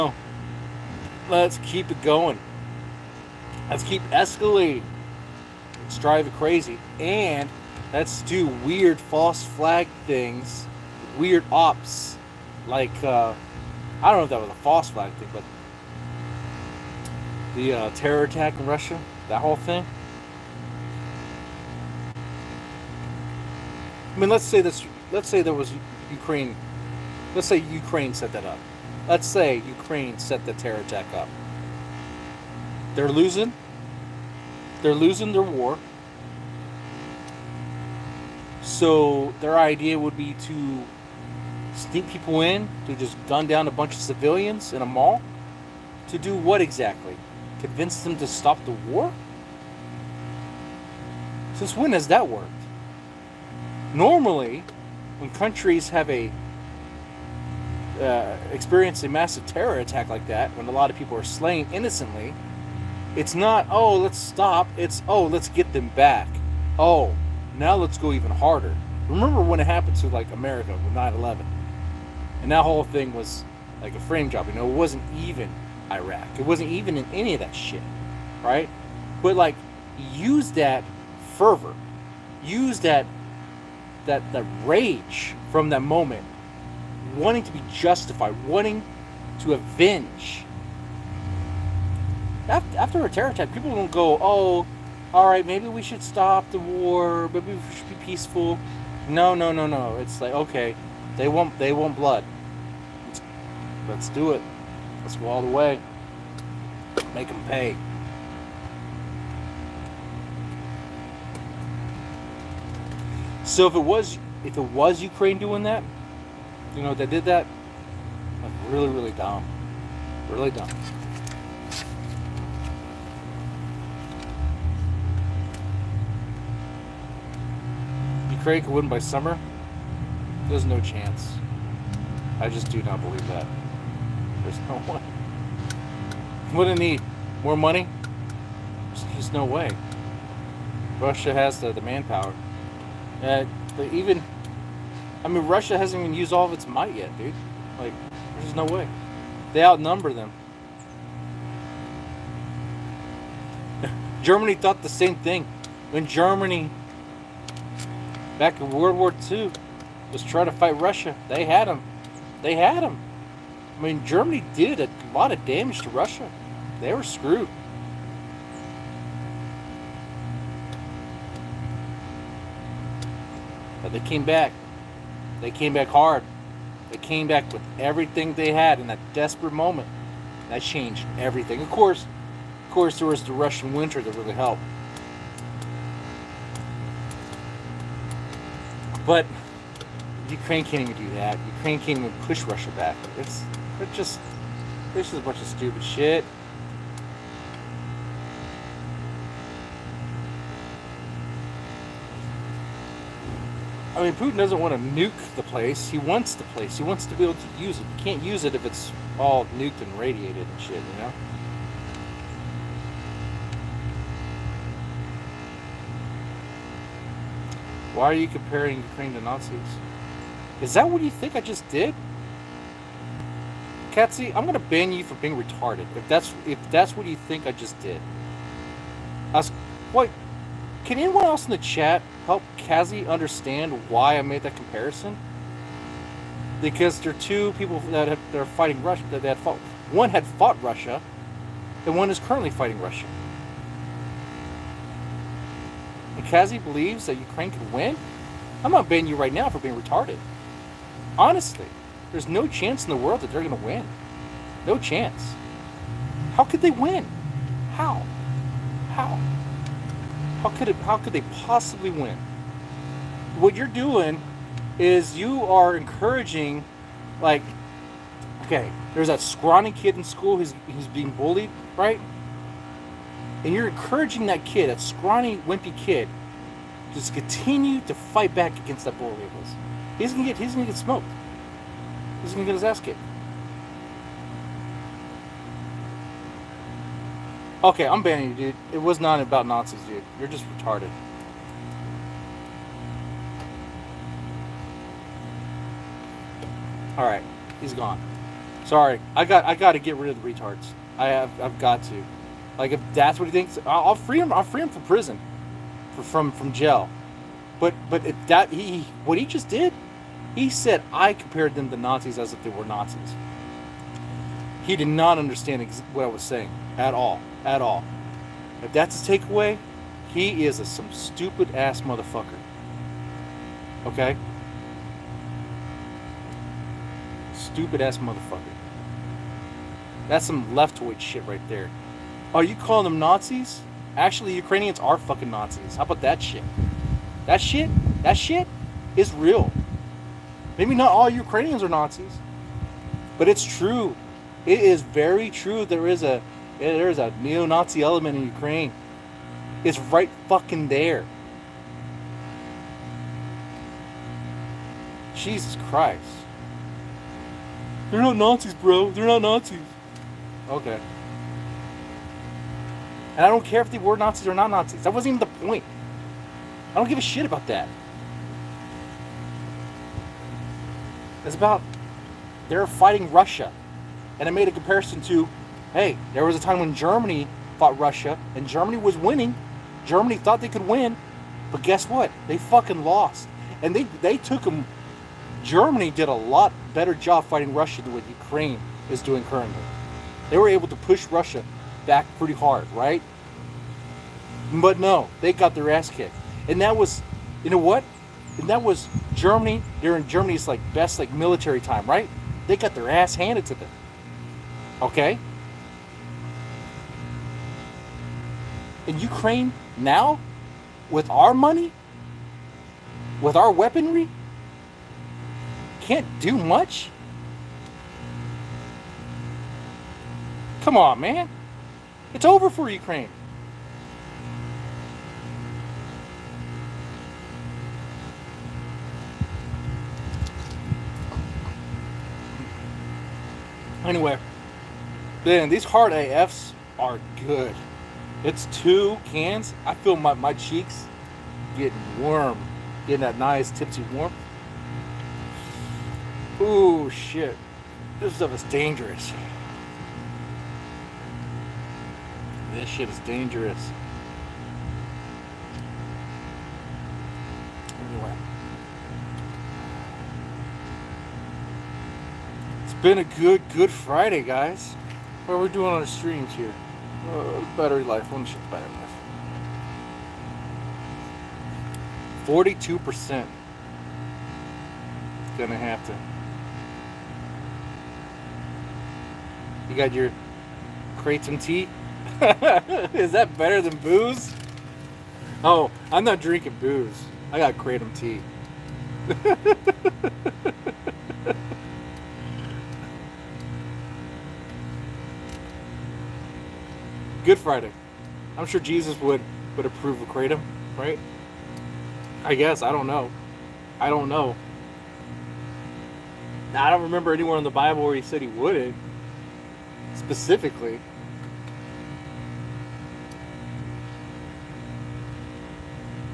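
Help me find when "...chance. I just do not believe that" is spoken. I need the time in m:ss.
2:10.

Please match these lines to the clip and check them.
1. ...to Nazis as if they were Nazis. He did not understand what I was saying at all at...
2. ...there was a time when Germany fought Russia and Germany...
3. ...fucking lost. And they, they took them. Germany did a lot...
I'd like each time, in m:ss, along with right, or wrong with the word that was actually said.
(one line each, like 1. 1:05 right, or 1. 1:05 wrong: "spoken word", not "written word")
1. 5:11 right
2. 6:16 right
3. 6:22 right.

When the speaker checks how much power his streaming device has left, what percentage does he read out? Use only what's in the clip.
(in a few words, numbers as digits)
42%.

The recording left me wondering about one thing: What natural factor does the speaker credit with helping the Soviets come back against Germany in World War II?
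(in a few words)
the Russian winter.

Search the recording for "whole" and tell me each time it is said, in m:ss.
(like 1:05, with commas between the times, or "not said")
0:19, 1:12.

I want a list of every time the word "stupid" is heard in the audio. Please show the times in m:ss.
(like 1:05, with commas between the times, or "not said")
3:15, 5:20, 5:27.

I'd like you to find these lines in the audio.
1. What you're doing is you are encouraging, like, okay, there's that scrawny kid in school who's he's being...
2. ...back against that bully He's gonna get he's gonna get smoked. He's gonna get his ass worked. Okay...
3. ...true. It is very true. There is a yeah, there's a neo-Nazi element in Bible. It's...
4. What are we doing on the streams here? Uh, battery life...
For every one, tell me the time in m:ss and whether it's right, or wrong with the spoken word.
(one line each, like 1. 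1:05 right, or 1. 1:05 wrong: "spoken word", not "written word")
1. 4:23 right
2. 4:38 wrong: "kicked", not "worked"
3. 5:43 wrong: "Ukraine", not "Bible"
4. 7:45 right.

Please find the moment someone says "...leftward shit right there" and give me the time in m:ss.
5:30.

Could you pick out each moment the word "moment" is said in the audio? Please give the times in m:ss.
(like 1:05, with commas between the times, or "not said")
1:25, 2:59.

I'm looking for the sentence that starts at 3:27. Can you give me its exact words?
You can't use it if it's all nuked and radiated and shit, you know?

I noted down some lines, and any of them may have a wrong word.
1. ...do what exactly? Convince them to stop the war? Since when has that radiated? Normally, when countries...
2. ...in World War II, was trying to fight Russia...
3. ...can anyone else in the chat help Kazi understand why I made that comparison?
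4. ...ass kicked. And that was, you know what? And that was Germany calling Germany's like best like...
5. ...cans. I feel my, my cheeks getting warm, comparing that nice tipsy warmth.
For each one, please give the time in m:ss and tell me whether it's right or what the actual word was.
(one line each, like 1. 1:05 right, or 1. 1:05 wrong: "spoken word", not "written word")
1. 0:46 wrong: "worked", not "radiated"
2. 2:38 right
3. 3:50 right
4. 6:35 wrong: "during", not "calling"
5. 7:19 wrong: "getting", not "comparing".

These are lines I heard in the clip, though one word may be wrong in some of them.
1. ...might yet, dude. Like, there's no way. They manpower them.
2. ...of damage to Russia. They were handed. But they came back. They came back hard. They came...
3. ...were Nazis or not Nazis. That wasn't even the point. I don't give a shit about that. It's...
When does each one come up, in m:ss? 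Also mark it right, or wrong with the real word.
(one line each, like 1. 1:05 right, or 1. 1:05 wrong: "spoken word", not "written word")
1. 2:26 wrong: "outnumber", not "manpower"
2. 2:45 wrong: "screwed", not "handed"
3. 6:03 right.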